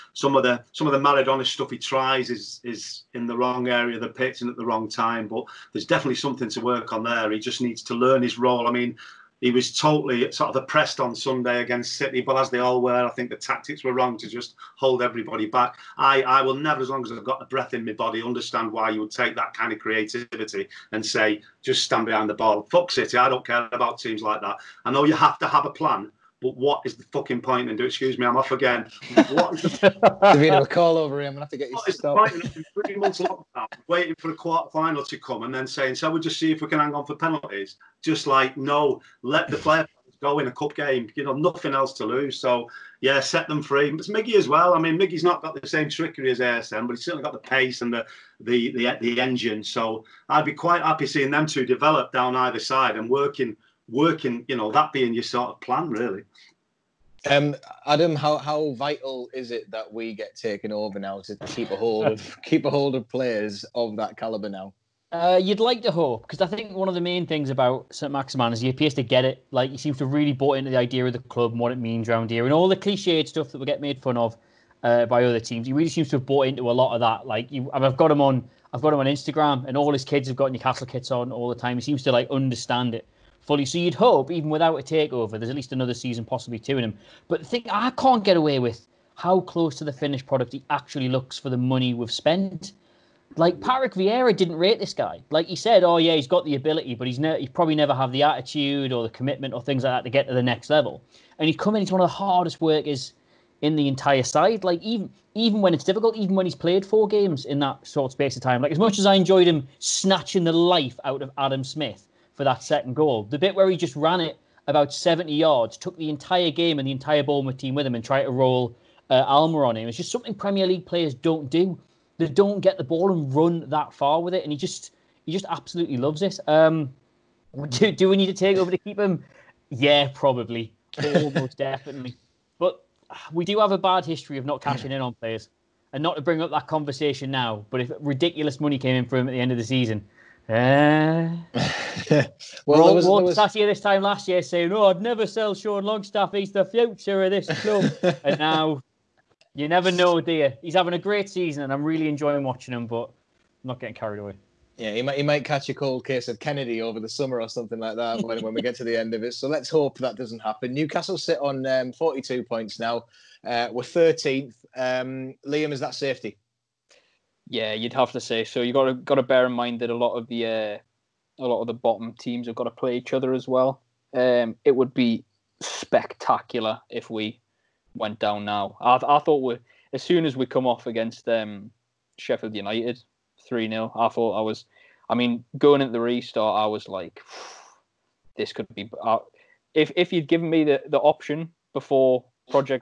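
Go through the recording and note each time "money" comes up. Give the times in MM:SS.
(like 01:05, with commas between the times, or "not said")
01:31, 02:18.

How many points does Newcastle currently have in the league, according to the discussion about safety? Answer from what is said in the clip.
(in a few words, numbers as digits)
42.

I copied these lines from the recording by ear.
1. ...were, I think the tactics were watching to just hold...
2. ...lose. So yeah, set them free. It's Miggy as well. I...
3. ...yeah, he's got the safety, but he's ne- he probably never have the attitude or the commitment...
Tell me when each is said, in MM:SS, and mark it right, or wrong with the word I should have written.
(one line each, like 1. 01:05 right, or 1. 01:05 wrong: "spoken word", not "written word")
1. 00:12 wrong: "wrong", not "watching"
2. 00:42 right
3. 01:35 wrong: "ability", not "safety".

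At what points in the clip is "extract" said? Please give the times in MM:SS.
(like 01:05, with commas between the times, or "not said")
not said.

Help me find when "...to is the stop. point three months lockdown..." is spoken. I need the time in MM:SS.
00:31.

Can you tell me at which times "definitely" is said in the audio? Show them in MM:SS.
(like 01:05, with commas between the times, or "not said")
00:05, 02:11.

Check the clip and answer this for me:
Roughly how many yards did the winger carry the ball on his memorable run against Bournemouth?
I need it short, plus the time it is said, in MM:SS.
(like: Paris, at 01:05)
70, at 01:54.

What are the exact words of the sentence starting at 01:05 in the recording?
Uh, you'd like to hope because I think one of the main things about St Maximin is he appears to get it.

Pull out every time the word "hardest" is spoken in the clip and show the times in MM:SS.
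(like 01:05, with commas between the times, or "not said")
01:42.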